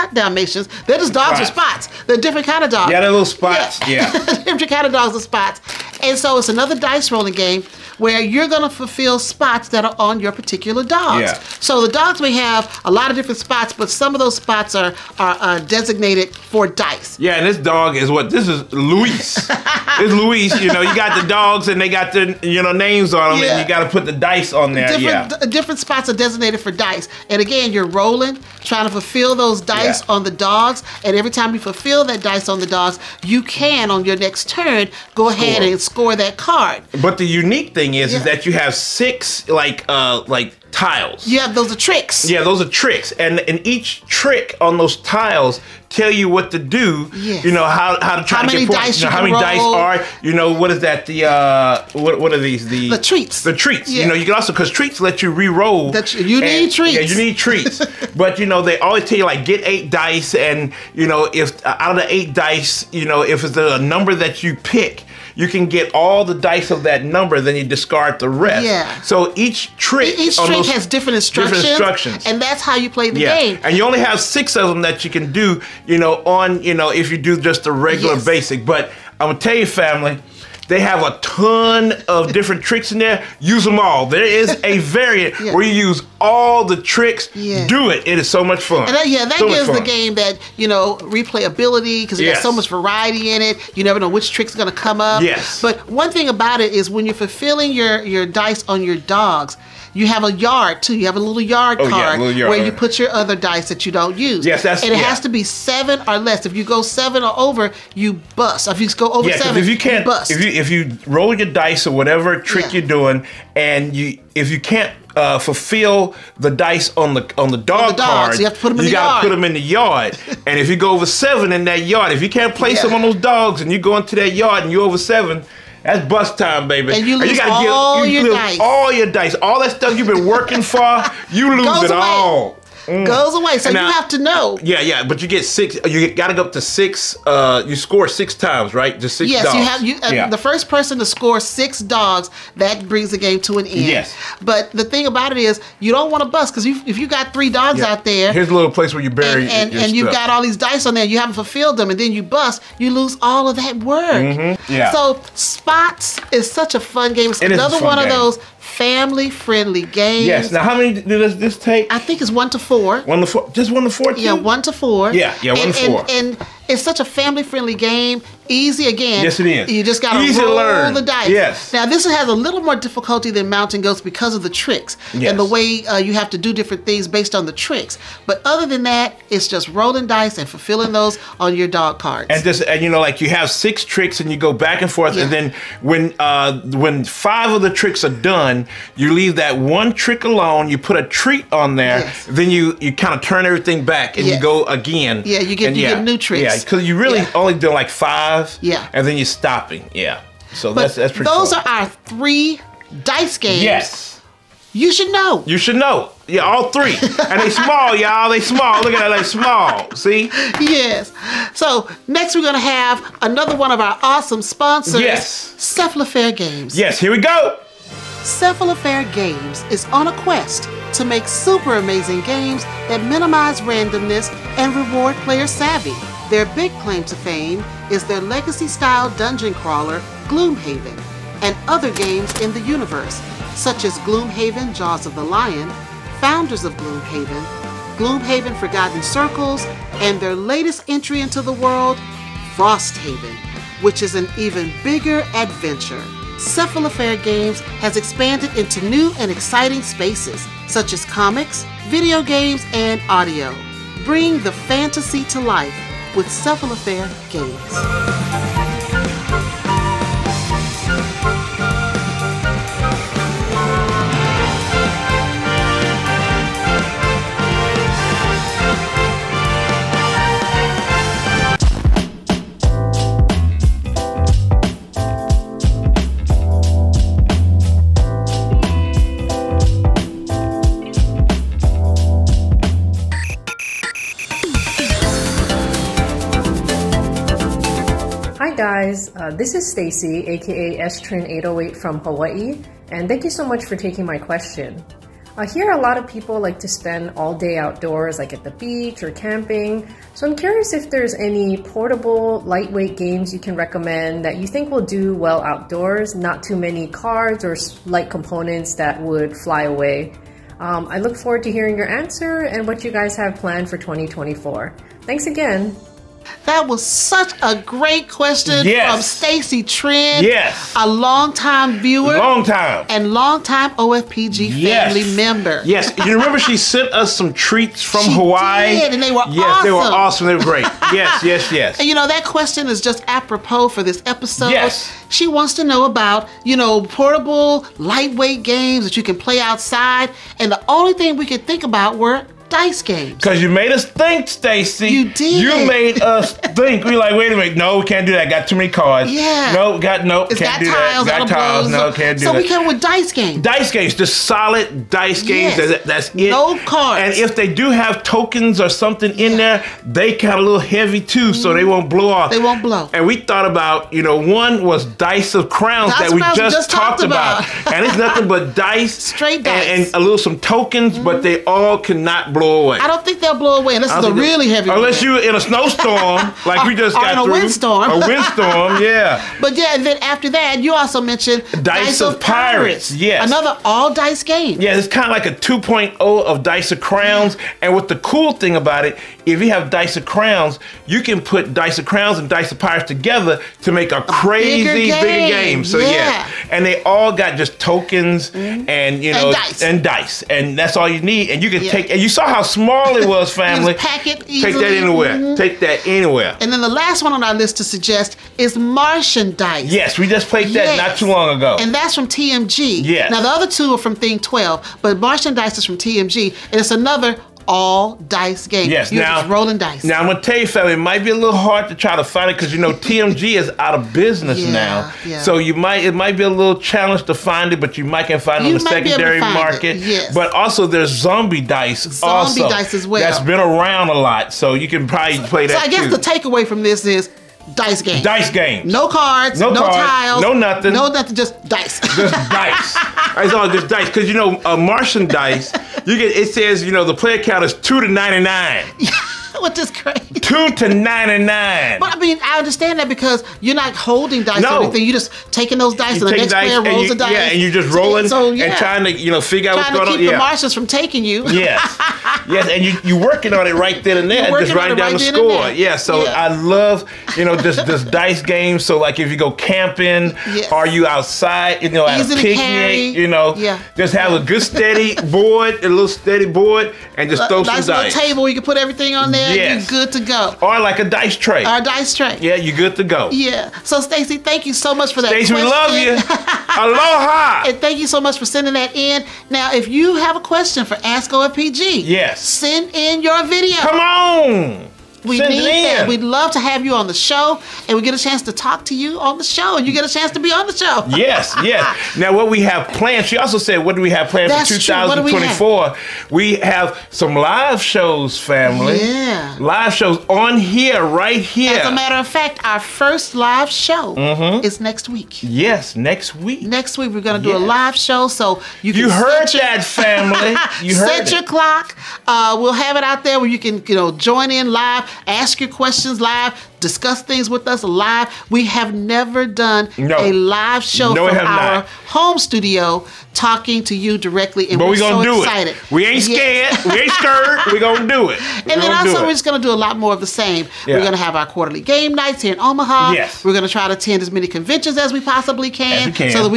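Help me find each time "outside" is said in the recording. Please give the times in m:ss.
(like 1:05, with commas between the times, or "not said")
5:39, 7:50.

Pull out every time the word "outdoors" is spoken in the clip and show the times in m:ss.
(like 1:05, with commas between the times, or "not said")
4:57, 5:05.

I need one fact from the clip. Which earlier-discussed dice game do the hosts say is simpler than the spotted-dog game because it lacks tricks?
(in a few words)
Mountain Goats.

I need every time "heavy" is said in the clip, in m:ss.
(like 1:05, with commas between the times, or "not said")
6:00, 6:14.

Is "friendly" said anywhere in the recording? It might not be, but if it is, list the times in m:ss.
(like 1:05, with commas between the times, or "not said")
2:39, 2:47.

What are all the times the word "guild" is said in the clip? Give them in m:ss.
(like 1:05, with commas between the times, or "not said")
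not said.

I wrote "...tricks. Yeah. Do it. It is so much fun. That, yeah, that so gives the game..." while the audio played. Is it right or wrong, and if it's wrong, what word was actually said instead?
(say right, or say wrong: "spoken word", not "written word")
right.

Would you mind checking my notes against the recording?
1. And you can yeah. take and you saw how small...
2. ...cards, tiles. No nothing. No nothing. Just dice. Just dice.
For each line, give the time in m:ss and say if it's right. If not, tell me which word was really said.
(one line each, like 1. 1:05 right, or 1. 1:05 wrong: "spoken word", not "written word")
1. 6:41 right
2. 7:19 right.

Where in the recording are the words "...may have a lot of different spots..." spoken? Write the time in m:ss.
0:12.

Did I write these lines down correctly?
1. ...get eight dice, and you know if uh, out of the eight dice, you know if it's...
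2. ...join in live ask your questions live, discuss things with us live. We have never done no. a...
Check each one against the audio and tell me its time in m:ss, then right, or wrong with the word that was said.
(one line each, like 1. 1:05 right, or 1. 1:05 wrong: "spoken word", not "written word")
1. 0:59 right
2. 8:43 right.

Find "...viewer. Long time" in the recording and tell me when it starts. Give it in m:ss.
5:21.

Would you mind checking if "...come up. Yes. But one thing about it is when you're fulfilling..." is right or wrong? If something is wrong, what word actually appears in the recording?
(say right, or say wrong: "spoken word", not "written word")
right.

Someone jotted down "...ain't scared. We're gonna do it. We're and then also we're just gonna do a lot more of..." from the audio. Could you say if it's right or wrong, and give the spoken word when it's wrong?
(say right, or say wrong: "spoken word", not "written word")
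right.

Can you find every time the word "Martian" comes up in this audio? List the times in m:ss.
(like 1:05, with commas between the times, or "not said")
6:48, 6:54, 7:24, 7:40.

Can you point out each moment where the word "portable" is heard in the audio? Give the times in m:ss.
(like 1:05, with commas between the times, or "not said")
5:01, 5:36.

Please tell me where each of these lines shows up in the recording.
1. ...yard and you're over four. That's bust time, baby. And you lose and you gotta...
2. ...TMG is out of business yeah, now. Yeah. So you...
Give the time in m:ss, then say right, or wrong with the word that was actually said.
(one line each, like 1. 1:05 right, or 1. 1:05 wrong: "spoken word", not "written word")
1. 2:04 wrong: "seven", not "four"
2. 7:02 right.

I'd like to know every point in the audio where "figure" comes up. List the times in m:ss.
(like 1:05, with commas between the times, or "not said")
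7:39.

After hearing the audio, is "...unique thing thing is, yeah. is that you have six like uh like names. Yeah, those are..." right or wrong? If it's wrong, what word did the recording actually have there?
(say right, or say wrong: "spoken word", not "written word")
wrong: "tiles", not "names".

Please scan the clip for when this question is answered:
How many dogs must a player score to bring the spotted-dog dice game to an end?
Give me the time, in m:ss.
2:21.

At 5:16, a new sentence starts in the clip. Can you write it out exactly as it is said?
That was such a great question yes.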